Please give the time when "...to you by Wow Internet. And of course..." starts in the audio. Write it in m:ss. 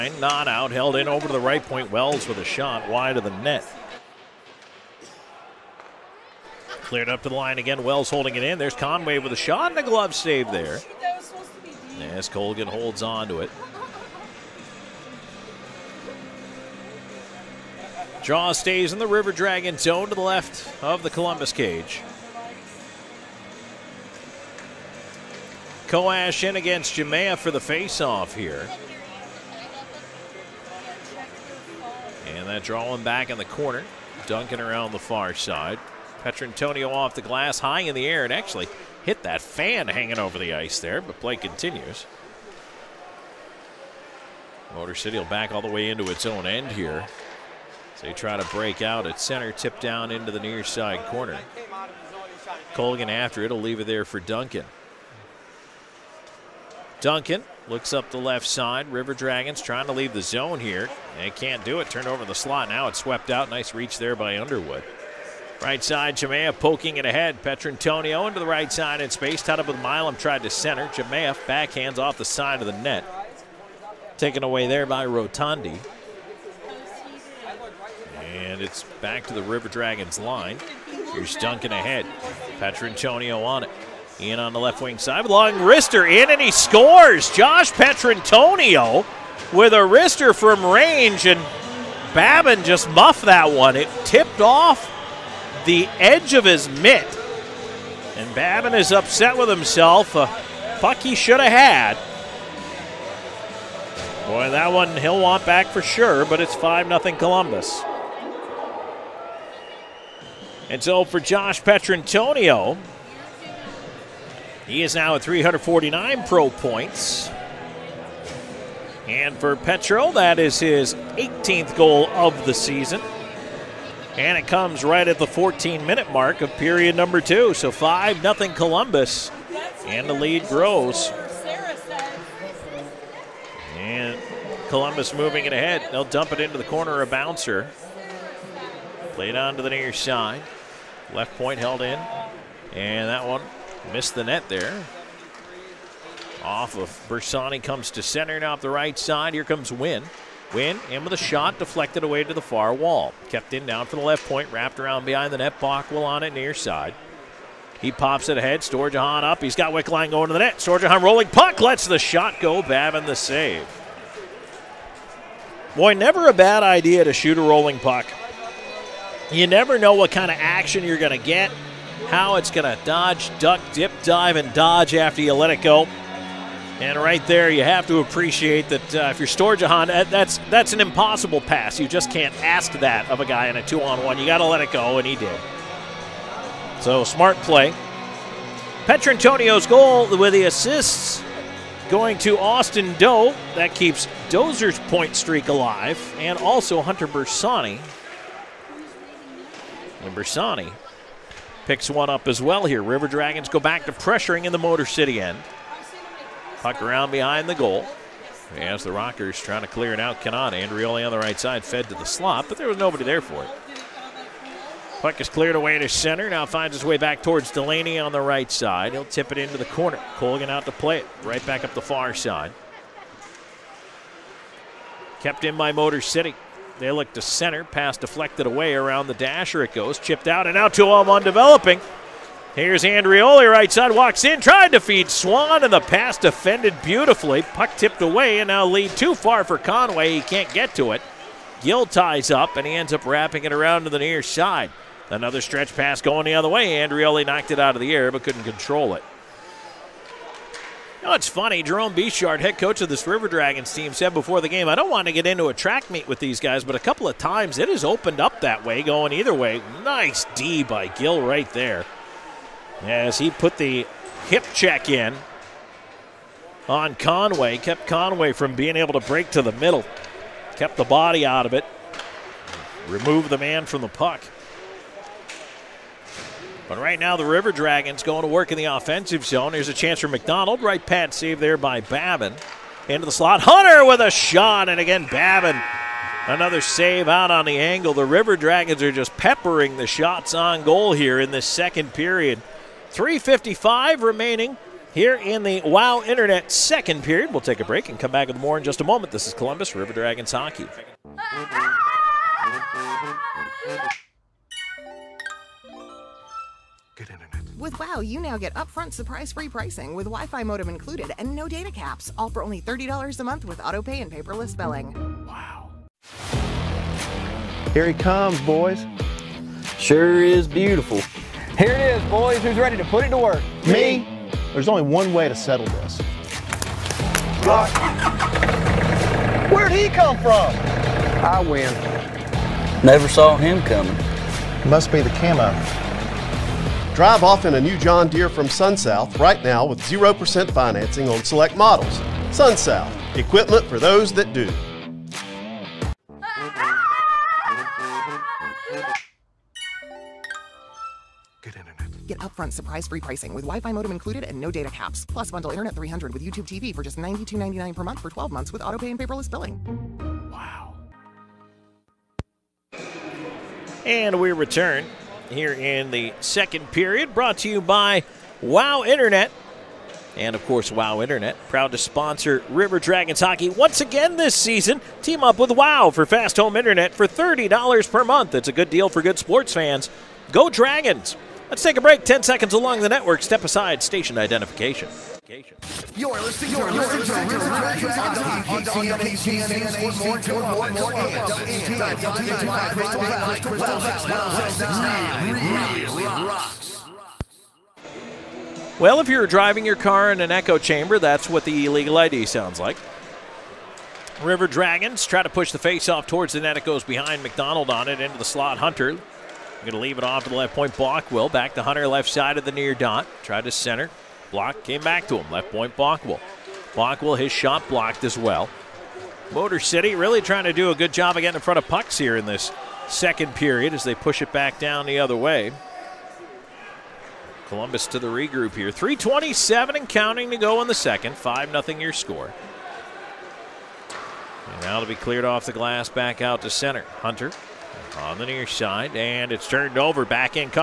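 6:07.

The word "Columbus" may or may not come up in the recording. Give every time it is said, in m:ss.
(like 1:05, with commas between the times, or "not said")
0:21, 1:47, 2:08, 2:14, 4:59, 7:07.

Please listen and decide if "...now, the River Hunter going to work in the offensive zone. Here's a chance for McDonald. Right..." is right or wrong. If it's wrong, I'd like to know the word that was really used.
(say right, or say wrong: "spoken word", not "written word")
wrong: "Dragons", not "Hunter".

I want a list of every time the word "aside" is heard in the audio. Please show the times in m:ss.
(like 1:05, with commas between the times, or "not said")
6:23.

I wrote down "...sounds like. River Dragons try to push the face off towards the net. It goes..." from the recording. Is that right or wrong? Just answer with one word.
right.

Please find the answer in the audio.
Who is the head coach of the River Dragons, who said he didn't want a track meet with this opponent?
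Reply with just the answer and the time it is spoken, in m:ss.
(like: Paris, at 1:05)
Jerome Bechard, at 4:11.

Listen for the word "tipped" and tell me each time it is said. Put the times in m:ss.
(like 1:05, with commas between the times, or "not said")
1:34, 3:57.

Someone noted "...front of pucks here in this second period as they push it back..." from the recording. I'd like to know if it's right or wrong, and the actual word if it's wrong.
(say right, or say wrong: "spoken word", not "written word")
right.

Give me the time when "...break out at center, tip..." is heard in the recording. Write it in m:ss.
0:48.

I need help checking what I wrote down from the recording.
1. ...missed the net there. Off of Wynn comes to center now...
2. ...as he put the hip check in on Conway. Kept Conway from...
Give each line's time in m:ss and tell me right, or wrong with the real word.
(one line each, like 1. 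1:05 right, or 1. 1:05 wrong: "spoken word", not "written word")
1. 2:23 wrong: "Bersani", not "Wynn"
2. 4:22 right.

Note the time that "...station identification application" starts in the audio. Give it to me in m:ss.
6:23.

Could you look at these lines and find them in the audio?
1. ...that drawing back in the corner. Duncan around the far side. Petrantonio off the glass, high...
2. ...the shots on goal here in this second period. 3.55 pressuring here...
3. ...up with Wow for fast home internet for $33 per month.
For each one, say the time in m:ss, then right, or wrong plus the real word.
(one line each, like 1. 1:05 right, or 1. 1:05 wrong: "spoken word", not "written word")
1. 0:32 right
2. 4:49 wrong: "remaining", not "pressuring"
3. 6:15 wrong: "30", not "33".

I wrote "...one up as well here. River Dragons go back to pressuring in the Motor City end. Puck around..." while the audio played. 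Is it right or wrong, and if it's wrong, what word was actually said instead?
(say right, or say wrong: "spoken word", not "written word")
right.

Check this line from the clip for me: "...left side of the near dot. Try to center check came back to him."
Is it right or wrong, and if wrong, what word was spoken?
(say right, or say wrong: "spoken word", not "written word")
wrong: "block", not "check".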